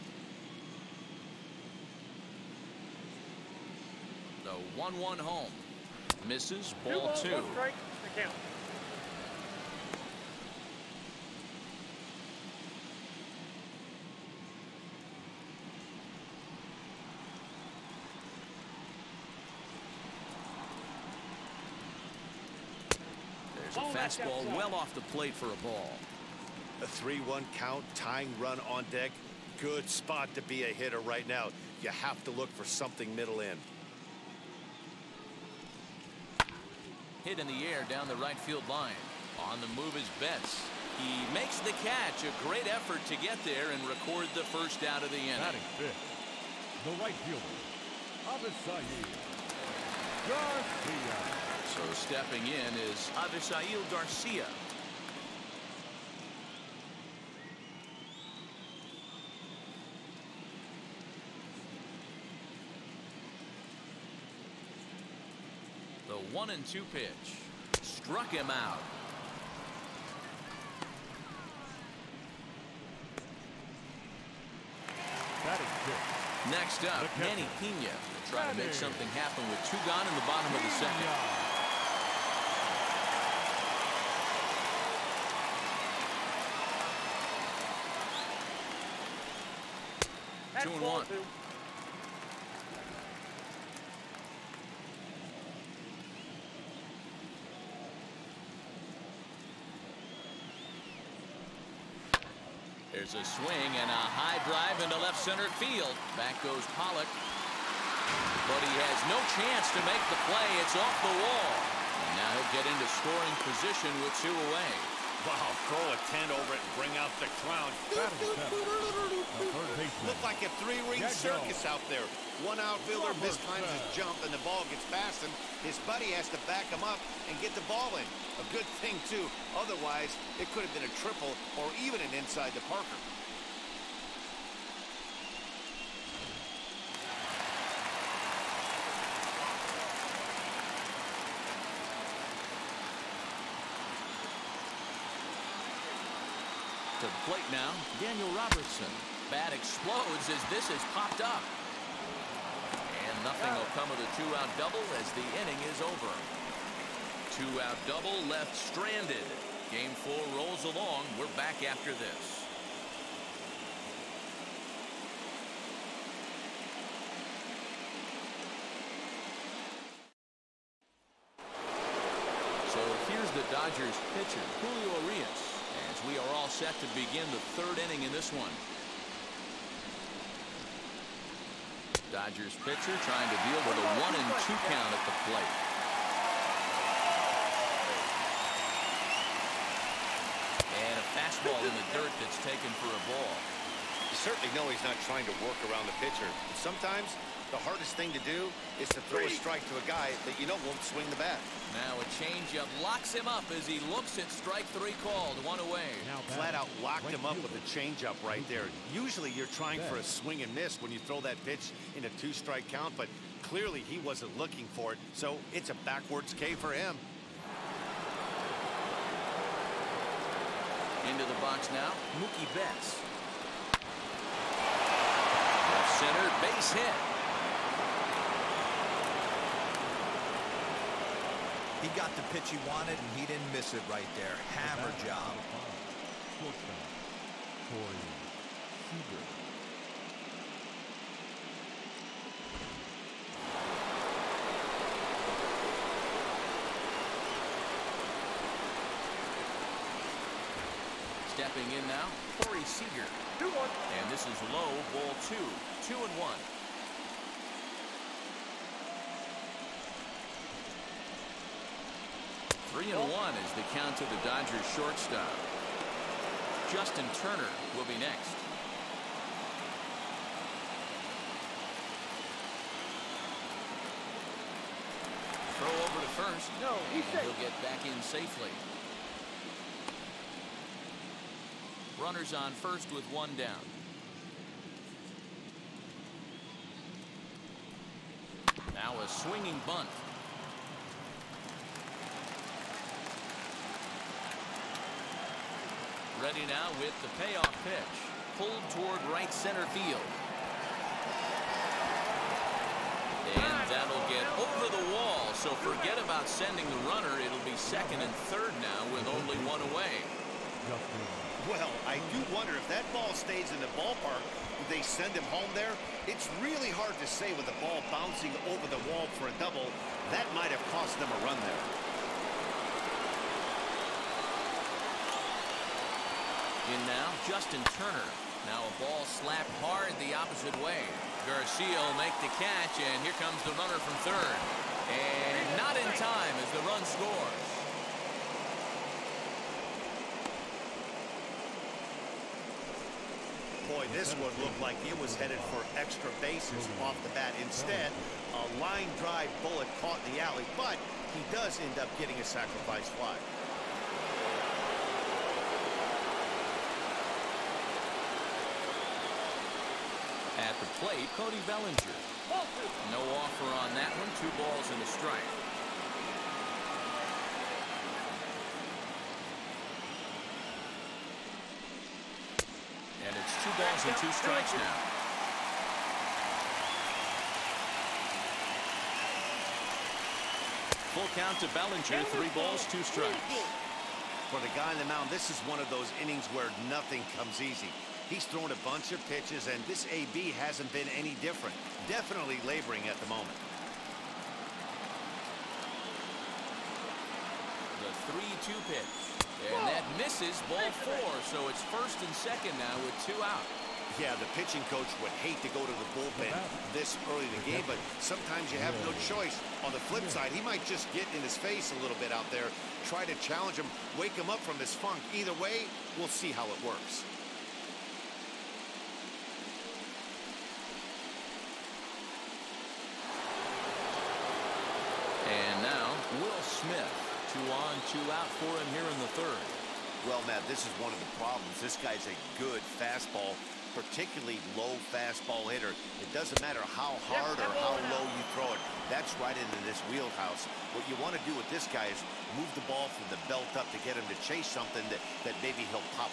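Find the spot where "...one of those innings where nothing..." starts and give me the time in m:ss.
6:25.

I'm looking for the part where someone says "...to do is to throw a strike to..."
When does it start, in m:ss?
3:18.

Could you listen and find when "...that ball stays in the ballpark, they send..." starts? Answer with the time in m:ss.
5:12.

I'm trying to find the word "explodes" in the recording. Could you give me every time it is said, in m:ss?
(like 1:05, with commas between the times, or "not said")
2:29.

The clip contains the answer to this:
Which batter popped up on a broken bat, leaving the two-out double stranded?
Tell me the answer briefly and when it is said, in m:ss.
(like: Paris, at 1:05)
Daniel Robertson, at 2:28.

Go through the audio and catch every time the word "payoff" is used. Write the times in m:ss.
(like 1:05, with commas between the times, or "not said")
4:57.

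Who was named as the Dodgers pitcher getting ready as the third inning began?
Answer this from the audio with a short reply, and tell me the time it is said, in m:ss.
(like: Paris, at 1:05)
Julio Urías, at 2:54.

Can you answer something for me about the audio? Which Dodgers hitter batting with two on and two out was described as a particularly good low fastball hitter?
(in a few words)
Will Smith.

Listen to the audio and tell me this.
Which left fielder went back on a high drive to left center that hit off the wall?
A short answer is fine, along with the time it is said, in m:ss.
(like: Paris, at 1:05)
Pollock, at 1:46.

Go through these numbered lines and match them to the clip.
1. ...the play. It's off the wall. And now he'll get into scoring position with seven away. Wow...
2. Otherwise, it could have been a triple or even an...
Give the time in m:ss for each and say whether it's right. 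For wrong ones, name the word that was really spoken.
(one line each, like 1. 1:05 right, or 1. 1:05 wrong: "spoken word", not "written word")
1. 1:50 wrong: "two", not "seven"
2. 2:09 right.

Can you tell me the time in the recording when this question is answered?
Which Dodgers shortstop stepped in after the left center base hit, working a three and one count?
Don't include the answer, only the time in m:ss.
4:12.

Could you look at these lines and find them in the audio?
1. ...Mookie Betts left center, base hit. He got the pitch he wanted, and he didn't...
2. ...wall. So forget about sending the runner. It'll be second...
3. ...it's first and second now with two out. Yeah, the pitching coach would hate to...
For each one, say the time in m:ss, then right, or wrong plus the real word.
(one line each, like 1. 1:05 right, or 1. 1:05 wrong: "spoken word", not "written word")
1. 3:42 right
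2. 5:04 right
3. 6:41 right.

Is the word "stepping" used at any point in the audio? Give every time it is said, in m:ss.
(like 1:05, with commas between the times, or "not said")
0:51, 4:11.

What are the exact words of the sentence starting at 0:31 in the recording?
You have to look for something middle in.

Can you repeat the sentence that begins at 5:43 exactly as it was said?
this one looked like it was headed for extra bases off the bat.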